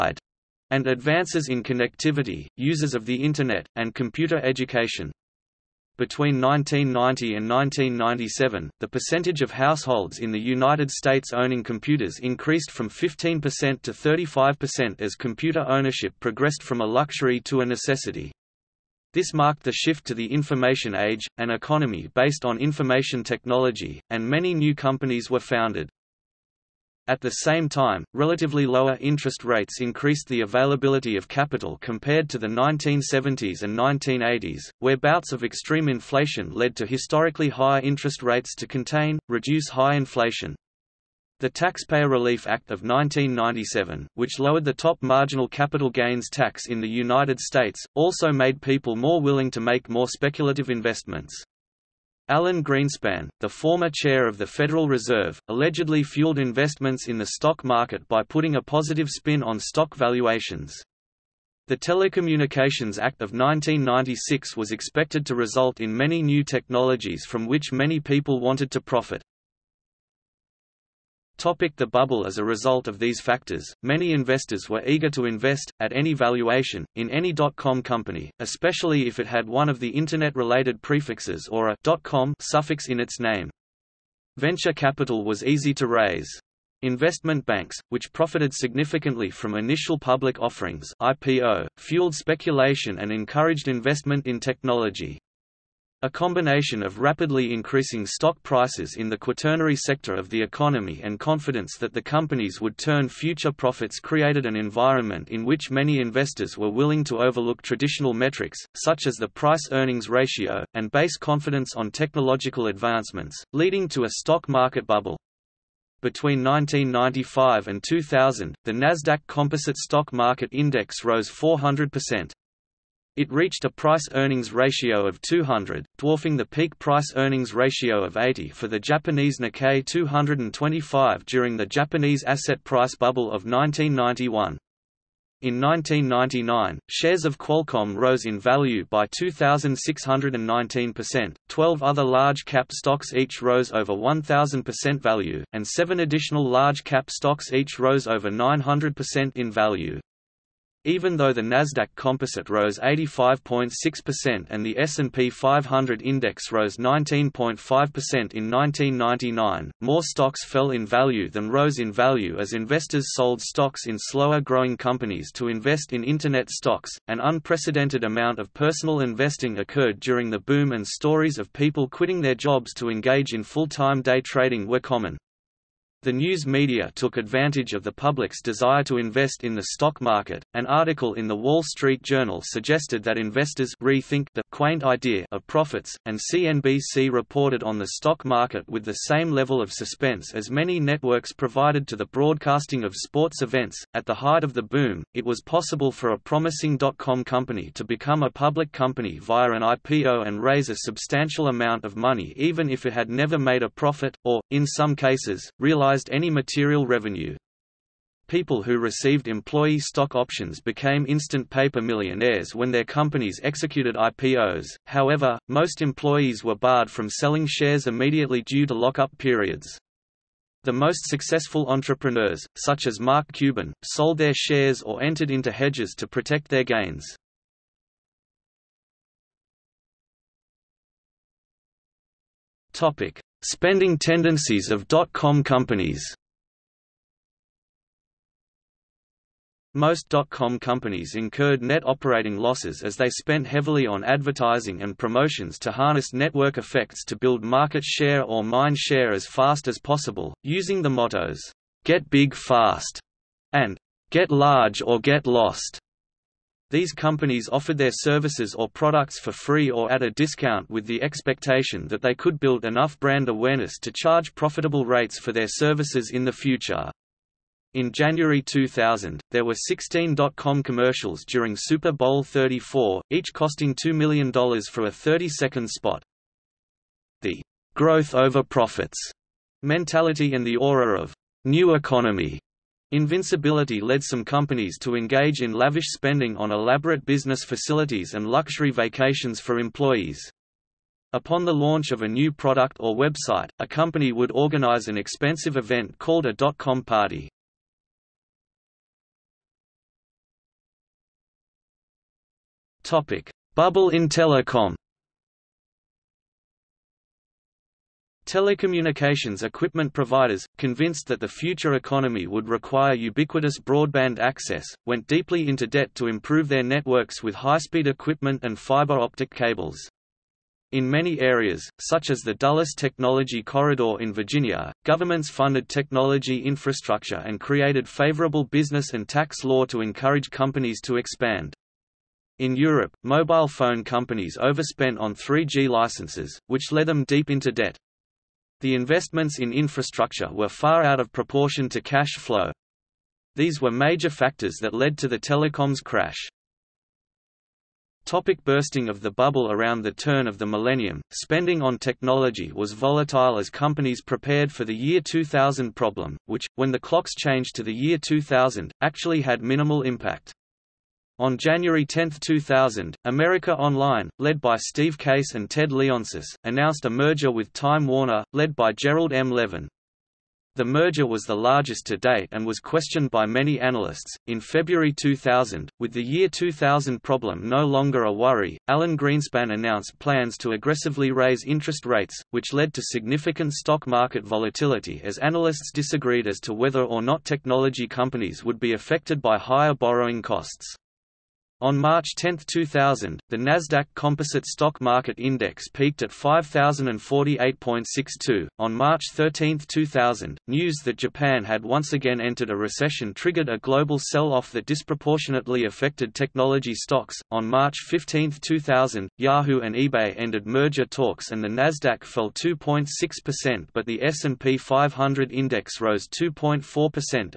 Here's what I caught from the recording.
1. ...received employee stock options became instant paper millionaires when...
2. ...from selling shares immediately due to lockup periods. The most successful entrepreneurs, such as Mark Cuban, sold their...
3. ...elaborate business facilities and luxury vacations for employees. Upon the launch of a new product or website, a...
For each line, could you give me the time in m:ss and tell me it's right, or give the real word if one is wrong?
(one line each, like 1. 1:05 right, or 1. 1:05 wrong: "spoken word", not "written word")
1. 3:28 right
2. 3:36 right
3. 4:46 right.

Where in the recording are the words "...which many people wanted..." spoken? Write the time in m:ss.
1:07.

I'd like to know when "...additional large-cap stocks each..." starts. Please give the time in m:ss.
2:26.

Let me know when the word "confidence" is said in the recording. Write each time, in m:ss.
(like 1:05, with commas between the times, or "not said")
1:41, 1:51.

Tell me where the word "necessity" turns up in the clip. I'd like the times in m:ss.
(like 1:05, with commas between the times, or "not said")
0:17.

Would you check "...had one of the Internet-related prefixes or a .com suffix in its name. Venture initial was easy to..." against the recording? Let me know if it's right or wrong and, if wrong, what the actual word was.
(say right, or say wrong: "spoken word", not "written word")
wrong: "capital", not "initial".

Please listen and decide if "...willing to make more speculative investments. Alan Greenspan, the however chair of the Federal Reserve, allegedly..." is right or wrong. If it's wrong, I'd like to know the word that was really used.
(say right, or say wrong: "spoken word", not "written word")
wrong: "former", not "however".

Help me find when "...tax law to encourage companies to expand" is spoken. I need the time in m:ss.
5:29.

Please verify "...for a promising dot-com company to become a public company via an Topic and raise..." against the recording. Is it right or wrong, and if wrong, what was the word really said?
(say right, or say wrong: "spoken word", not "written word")
wrong: "IPO", not "Topic".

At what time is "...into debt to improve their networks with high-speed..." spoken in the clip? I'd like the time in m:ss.
5:15.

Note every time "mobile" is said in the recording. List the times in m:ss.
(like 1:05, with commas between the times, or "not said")
5:33.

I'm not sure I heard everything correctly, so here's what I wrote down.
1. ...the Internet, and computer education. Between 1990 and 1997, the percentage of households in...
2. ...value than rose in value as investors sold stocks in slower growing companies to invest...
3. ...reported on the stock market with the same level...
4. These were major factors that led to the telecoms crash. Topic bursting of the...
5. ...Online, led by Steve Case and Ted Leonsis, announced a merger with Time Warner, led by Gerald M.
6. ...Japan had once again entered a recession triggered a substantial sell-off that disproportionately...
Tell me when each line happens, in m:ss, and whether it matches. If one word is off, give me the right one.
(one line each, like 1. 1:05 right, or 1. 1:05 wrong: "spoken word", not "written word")
1. 0:03 right
2. 2:40 right
3. 3:07 right
4. 5:43 right
5. 6:03 right
6. 6:40 wrong: "global", not "substantial".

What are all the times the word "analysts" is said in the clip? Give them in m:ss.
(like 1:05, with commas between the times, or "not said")
6:13, 6:25.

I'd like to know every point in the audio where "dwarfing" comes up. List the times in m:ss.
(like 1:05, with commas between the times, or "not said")
2:05.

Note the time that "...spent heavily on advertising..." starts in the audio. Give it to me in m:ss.
4:03.